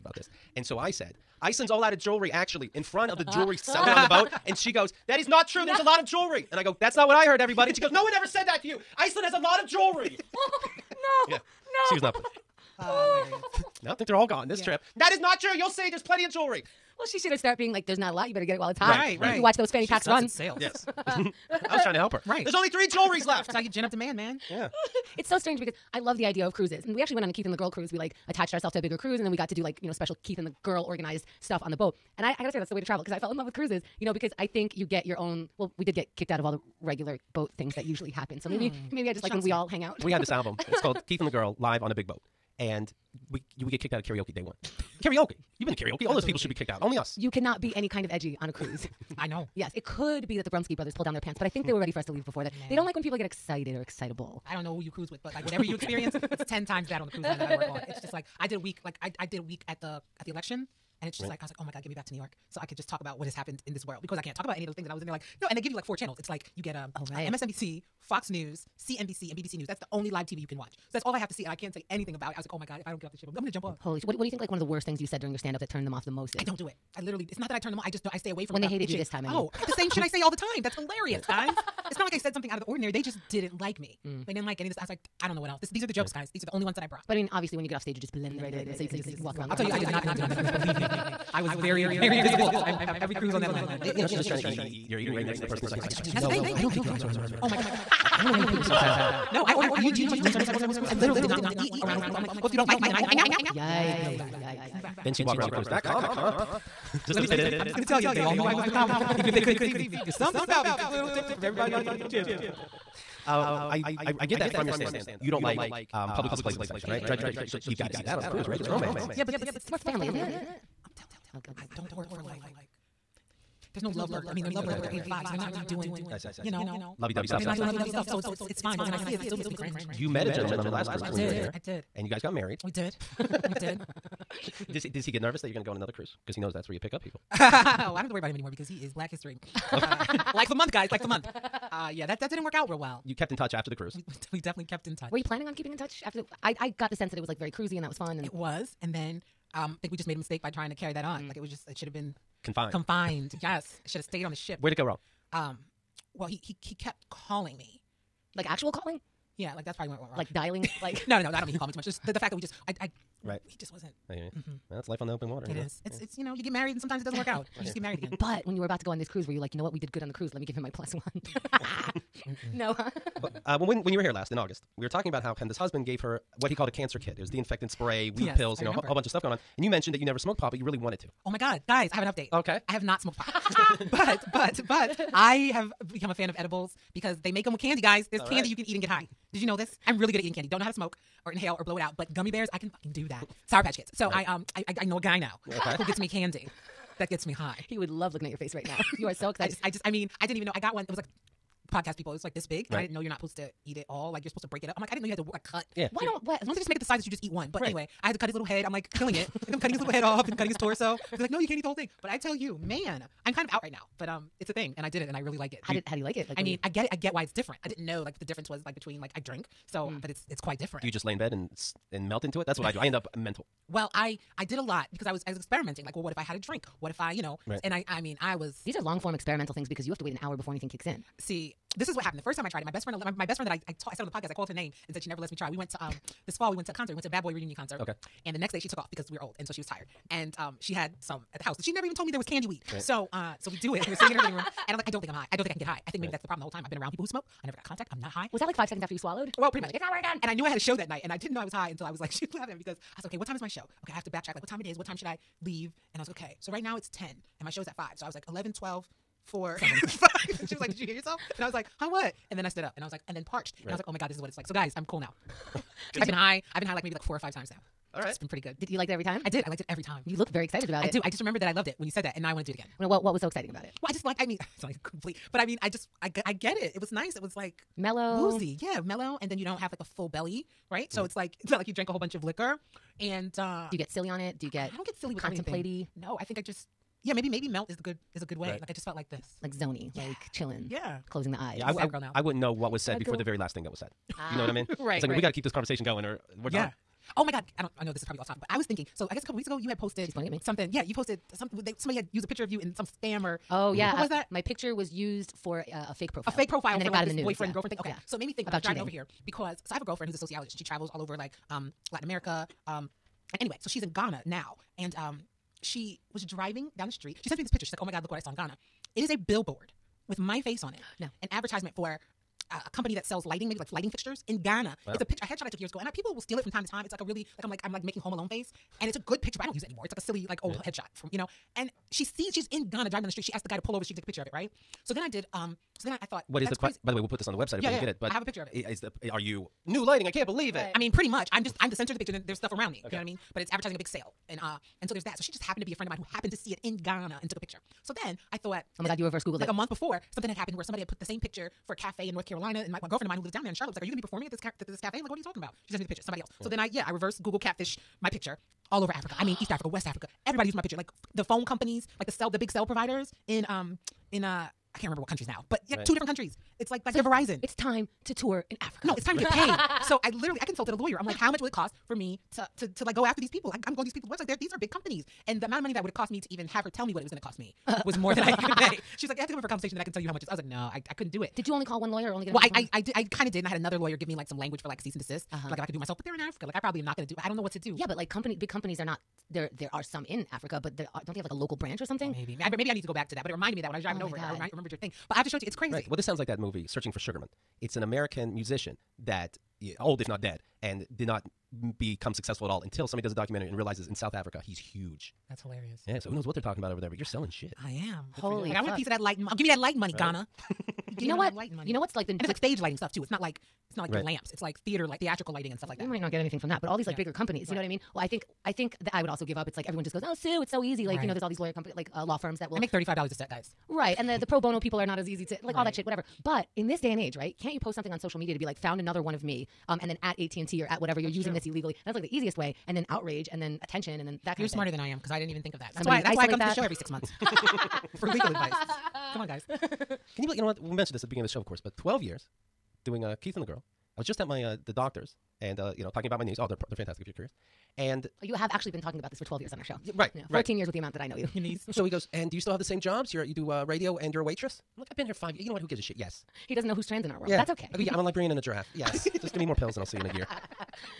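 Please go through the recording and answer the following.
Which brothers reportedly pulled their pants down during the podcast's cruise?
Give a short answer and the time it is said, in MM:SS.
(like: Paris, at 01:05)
Brumsky brothers, at 00:50.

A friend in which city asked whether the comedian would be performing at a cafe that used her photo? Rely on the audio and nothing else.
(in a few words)
Charlotte.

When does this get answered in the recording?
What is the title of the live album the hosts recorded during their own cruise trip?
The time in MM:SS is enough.
00:41.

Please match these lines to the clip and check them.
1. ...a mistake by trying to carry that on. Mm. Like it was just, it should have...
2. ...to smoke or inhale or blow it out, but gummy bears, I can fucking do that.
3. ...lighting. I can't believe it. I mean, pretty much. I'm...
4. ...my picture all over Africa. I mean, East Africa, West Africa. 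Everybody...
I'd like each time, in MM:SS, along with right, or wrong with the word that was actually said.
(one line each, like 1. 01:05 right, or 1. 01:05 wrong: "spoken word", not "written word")
1. 02:30 right
2. 03:10 right
3. 05:39 right
4. 05:58 right.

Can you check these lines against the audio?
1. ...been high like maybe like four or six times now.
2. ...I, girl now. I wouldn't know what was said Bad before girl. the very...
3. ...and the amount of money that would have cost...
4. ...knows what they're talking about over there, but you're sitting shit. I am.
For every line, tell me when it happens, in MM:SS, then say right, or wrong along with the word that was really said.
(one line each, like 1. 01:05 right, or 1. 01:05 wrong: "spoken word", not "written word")
1. 04:26 wrong: "five", not "six"
2. 04:51 right
3. 06:15 right
4. 06:46 wrong: "selling", not "sitting".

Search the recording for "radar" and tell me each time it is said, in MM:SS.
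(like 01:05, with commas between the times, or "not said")
not said.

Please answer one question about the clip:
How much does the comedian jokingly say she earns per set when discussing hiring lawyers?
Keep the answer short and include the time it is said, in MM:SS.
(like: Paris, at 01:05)
$35, at 07:02.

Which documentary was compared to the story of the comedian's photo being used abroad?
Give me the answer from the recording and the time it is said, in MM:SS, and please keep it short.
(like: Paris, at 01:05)
Searching for Sugarman, at 06:36.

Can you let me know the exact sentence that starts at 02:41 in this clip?
Just the, the fact that we just, I, I, right.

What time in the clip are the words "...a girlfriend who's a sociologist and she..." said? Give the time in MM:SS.
05:09.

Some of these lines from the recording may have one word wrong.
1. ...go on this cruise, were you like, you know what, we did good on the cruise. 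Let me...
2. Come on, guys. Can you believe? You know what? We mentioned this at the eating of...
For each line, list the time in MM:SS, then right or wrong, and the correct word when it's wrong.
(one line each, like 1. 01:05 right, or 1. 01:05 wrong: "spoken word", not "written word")
1. 02:48 right
2. 07:19 wrong: "beginning", not "eating".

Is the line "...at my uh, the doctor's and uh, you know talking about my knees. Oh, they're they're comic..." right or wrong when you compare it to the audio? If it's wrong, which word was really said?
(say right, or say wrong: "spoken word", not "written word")
wrong: "fantastic", not "comic".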